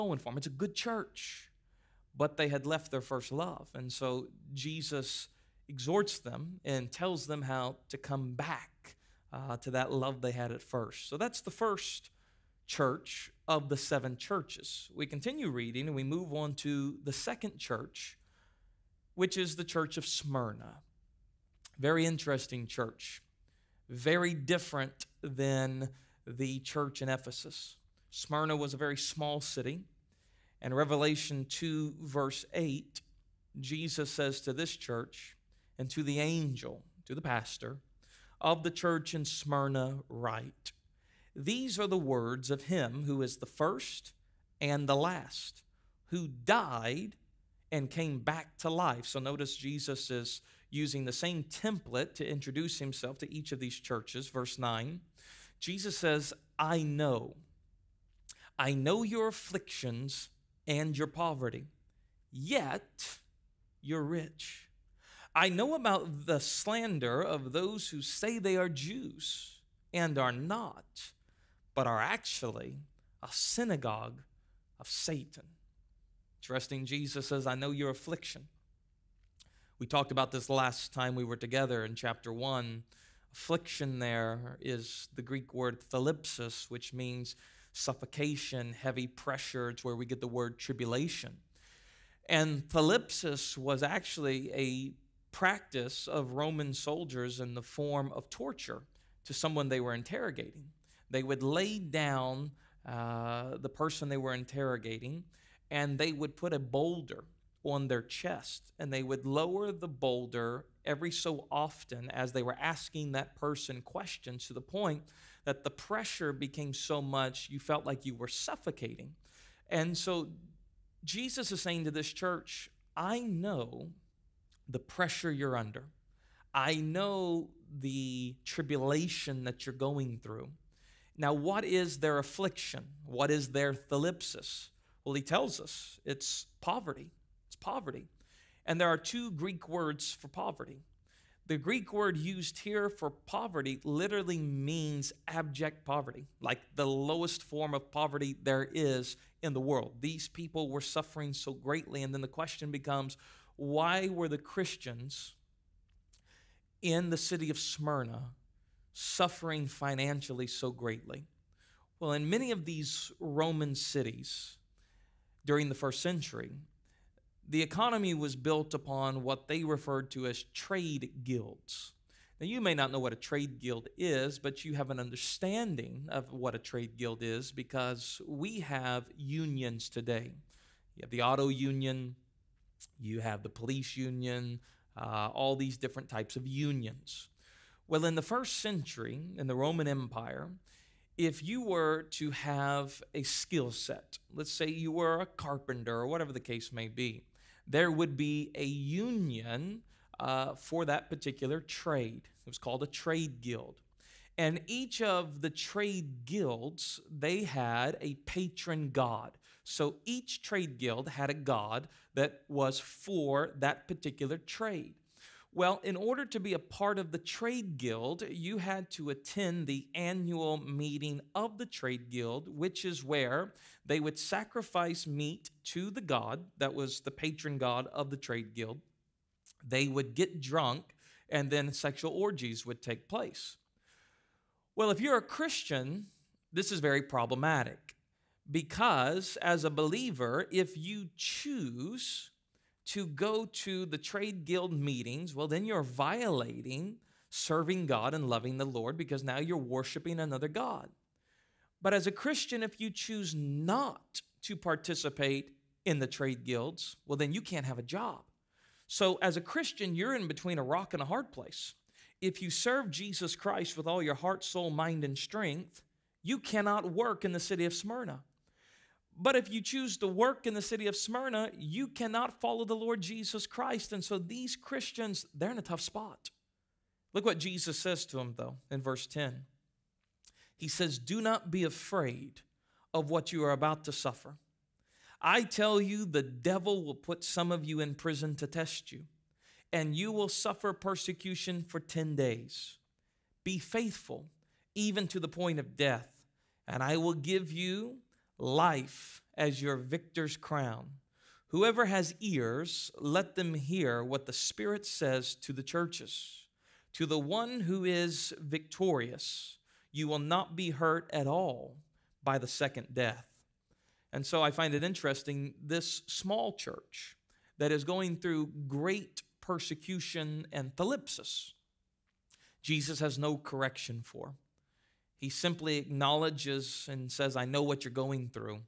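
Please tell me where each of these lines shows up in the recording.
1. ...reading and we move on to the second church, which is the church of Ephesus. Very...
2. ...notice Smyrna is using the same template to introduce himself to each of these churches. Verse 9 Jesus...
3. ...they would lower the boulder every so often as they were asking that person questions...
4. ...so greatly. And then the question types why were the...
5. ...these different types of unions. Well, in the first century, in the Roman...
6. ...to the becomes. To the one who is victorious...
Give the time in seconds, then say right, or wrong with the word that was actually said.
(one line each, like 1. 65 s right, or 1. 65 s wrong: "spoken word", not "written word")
1. 15 s wrong: "Smyrna", not "Ephesus"
2. 49 s wrong: "Jesus", not "Smyrna"
3. 108 s right
4. 151 s wrong: "becomes", not "types"
5. 185 s right
6. 305 s wrong: "churches", not "becomes".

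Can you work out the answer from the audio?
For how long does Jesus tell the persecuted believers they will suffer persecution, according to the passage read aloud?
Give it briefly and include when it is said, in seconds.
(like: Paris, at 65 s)
10 days, at 291 s.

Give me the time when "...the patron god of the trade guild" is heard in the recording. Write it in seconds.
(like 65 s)
226 s.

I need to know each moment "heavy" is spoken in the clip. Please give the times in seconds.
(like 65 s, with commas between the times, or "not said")
88 s.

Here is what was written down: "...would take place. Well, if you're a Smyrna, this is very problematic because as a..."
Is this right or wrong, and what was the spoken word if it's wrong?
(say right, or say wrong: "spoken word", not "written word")
wrong: "Christian", not "Smyrna".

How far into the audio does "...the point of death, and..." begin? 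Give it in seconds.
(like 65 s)
295 s.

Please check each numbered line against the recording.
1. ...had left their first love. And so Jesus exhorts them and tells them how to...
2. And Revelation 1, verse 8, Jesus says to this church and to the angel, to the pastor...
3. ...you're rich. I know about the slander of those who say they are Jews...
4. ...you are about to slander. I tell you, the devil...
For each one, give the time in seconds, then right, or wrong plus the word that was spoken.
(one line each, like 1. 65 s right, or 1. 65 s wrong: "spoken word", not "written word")
1. 2 s right
2. 30 s wrong: "2", not "1"
3. 63 s right
4. 283 s wrong: "suffer", not "slander".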